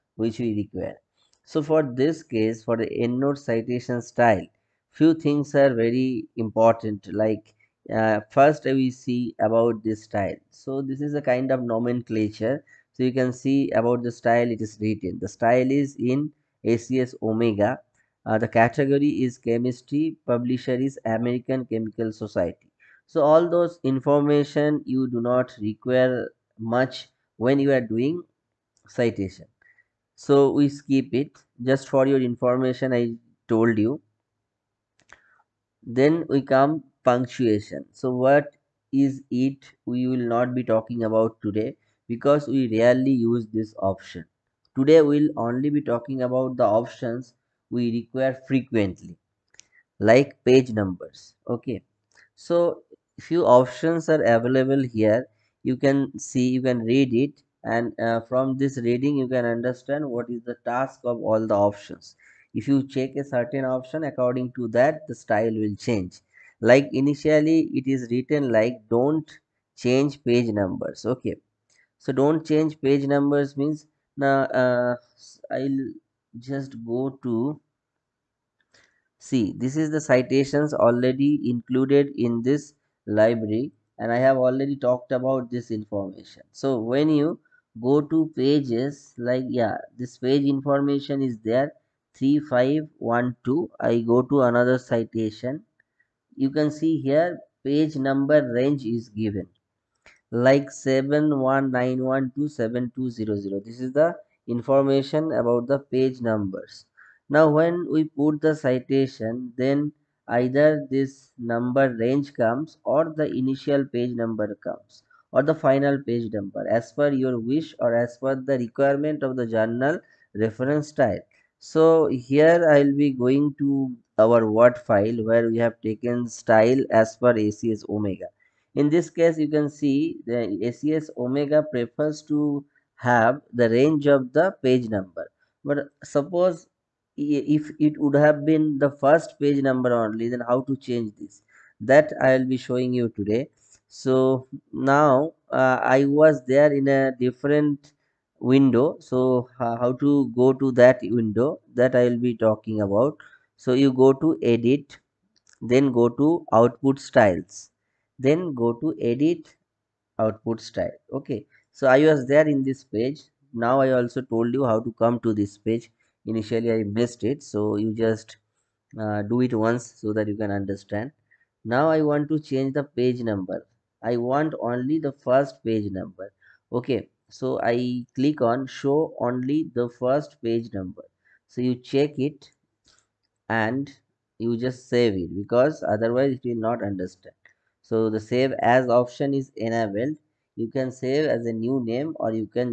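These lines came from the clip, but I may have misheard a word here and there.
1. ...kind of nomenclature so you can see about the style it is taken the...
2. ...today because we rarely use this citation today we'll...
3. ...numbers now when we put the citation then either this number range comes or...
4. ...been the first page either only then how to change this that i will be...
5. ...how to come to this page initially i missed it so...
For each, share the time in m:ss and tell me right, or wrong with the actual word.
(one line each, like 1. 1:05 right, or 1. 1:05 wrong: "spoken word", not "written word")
1. 0:11 wrong: "written", not "taken"
2. 0:41 wrong: "option", not "citation"
3. 1:46 right
4. 2:18 wrong: "number", not "either"
5. 2:44 right.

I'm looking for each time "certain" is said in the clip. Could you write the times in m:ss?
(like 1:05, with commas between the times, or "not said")
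1:03.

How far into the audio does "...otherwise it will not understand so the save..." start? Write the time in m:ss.
3:05.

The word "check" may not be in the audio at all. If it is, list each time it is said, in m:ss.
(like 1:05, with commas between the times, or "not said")
1:02, 3:01.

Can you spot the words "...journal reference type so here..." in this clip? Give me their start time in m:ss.
1:59.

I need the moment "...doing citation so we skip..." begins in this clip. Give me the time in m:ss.
0:27.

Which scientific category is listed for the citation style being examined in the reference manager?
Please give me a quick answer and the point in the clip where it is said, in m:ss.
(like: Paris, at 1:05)
Chemistry, at 0:19.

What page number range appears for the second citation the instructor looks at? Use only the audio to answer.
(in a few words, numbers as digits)
7191-7200.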